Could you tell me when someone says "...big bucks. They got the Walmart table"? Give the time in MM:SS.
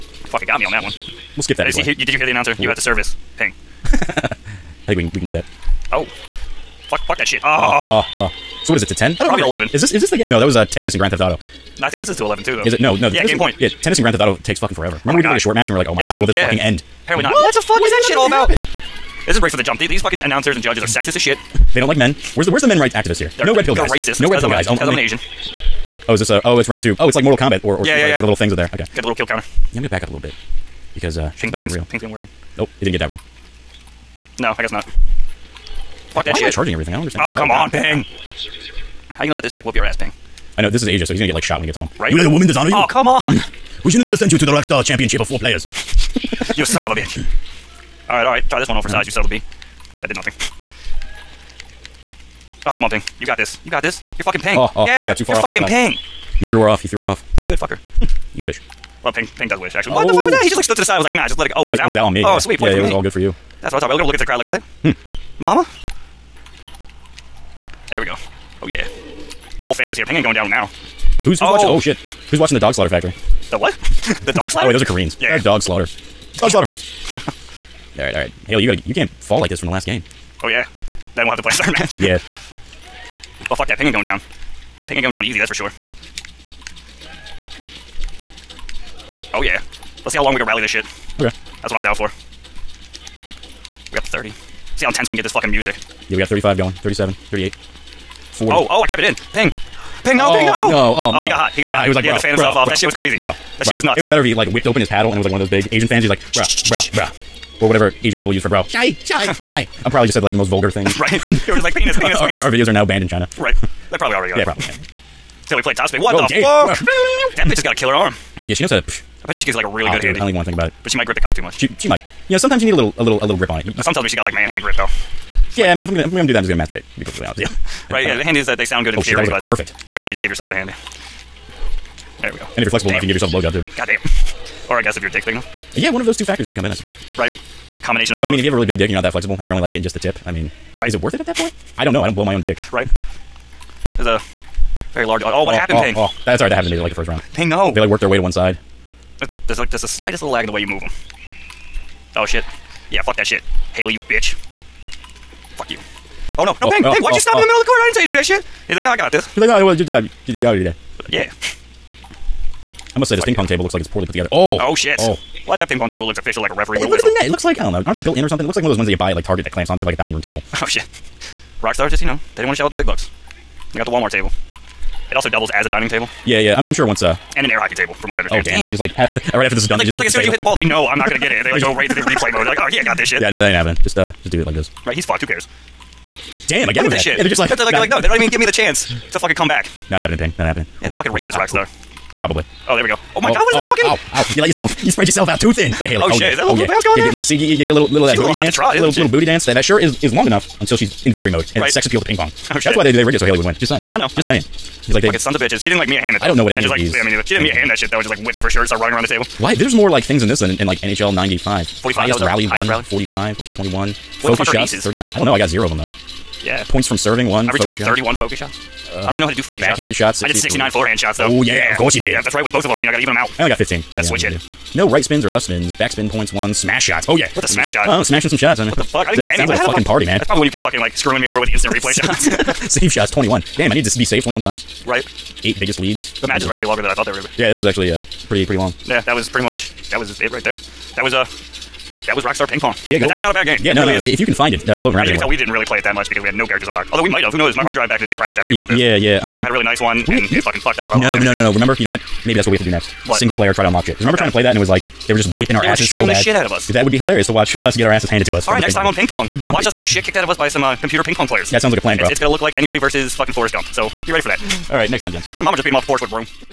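02:52.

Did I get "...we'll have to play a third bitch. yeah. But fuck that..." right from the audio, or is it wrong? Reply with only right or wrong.
wrong.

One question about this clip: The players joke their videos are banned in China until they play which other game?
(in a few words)
Topspin.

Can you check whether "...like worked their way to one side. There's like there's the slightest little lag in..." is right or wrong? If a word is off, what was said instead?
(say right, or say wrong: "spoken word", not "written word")
right.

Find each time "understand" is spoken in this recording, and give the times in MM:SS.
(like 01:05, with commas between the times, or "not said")
00:37, 02:58.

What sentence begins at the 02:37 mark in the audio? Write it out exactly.
I didn't tell you to do that shit.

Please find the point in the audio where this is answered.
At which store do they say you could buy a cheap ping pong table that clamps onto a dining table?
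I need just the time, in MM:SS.
02:49.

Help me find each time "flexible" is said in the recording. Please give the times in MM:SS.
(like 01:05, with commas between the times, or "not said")
02:12, 02:19.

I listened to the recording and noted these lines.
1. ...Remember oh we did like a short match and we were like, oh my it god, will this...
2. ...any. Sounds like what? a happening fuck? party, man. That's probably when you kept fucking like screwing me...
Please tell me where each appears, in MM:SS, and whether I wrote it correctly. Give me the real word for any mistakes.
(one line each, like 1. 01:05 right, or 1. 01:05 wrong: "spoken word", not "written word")
1. 00:15 right
2. 03:49 wrong: "fucking", not "happening".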